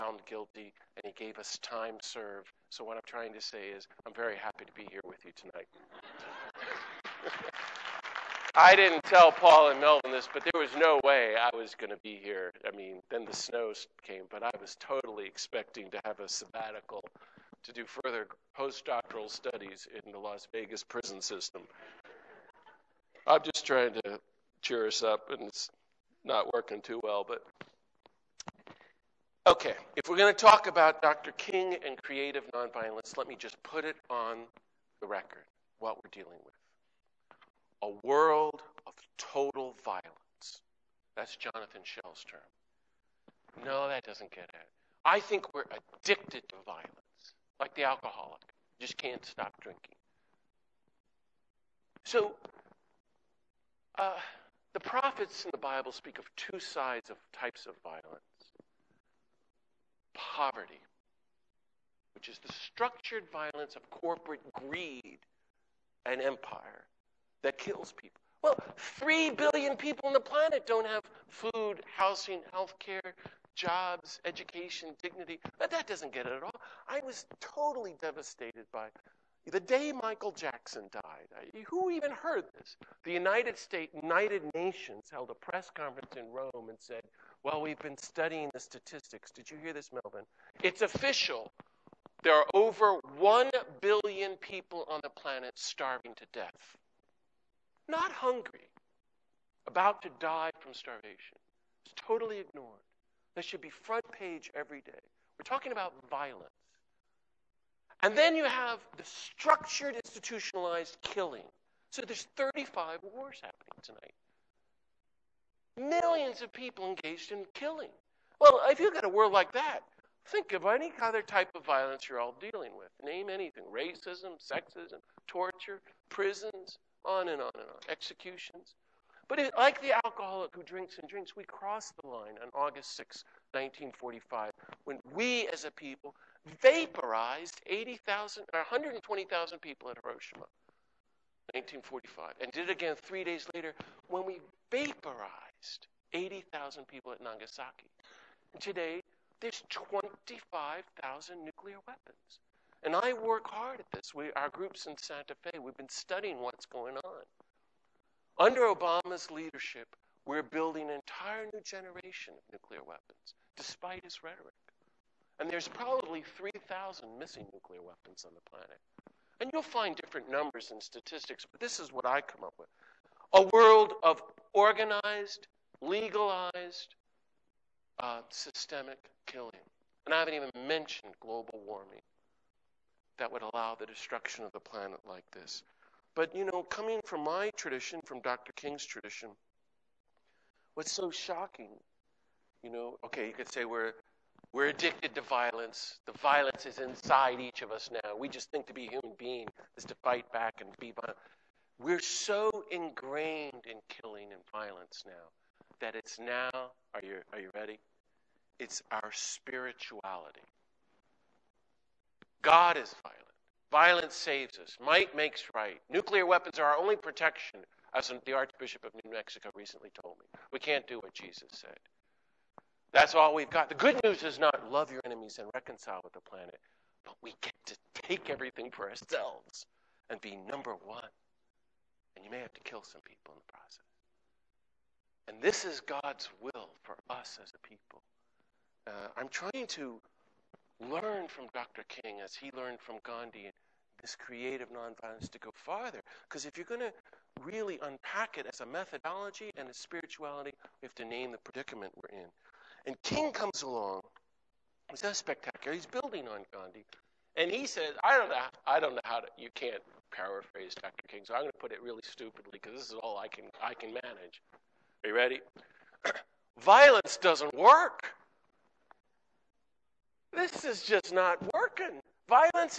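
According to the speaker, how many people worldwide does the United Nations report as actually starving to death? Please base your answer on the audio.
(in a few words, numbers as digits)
over 1 billion.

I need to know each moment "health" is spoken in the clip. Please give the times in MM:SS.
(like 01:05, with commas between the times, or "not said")
01:12.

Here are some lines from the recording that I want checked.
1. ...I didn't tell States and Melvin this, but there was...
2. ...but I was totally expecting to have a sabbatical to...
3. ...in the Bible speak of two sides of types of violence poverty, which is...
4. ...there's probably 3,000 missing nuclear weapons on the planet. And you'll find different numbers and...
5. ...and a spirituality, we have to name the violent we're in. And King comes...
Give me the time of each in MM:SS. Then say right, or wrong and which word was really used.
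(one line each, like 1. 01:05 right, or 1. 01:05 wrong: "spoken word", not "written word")
1. 00:08 wrong: "Paul", not "States"
2. 00:14 right
3. 00:55 right
4. 02:45 right
5. 04:09 wrong: "predicament", not "violent".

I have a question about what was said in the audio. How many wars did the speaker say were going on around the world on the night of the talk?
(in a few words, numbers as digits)
35.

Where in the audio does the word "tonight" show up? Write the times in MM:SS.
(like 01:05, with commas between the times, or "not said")
00:05, 01:53.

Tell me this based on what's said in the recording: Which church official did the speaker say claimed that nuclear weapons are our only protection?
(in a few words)
Archbishop of New Mexico.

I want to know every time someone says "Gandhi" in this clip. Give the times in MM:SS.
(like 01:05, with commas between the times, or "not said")
04:03, 04:16.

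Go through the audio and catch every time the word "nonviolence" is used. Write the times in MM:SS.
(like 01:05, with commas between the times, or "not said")
00:32, 04:04.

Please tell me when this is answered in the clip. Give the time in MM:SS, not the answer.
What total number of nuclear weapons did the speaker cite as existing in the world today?
02:29.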